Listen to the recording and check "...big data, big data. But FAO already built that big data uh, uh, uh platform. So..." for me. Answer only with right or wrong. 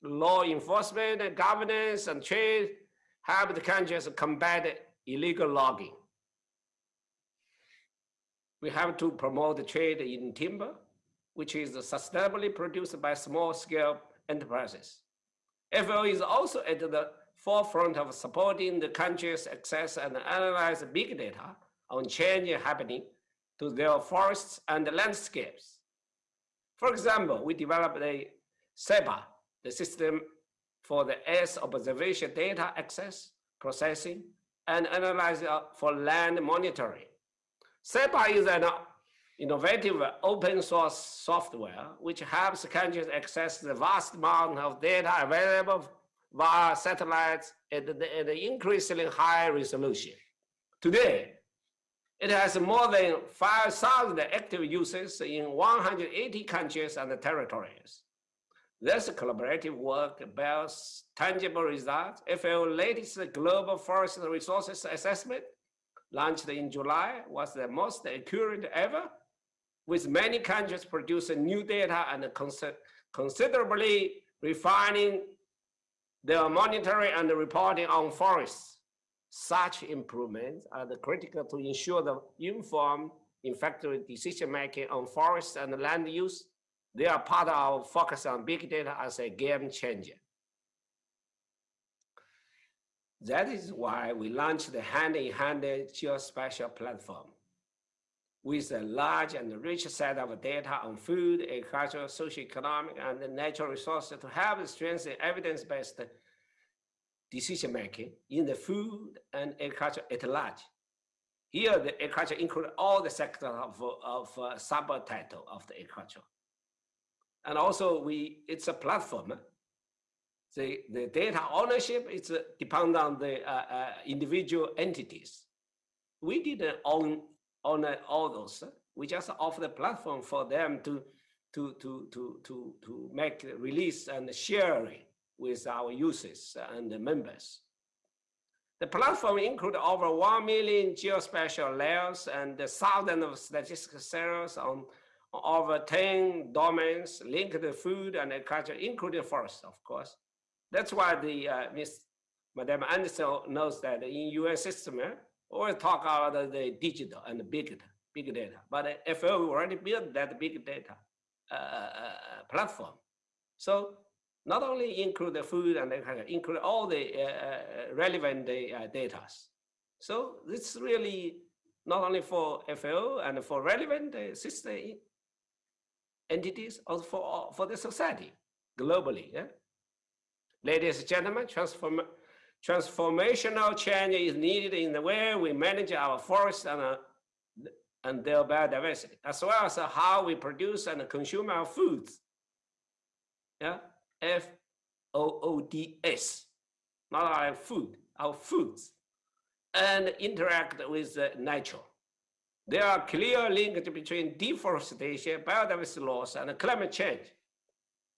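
right.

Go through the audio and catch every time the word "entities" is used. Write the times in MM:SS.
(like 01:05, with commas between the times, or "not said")
02:04, 02:56.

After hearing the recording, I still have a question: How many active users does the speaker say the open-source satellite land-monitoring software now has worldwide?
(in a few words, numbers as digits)
more than 5,000.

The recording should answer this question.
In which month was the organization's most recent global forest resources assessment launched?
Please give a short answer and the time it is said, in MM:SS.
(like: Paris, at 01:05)
July, at 01:06.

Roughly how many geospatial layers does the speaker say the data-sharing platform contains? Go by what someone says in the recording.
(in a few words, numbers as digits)
over 1 million.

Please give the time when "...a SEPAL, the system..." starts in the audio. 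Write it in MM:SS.
00:28.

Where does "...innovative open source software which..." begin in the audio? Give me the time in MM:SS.
00:39.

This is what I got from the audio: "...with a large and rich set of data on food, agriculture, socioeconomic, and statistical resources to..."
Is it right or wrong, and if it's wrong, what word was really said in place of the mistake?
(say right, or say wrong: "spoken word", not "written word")
wrong: "natural", not "statistical".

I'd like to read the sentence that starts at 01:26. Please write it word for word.
They are part of our focus on big data as a game changer.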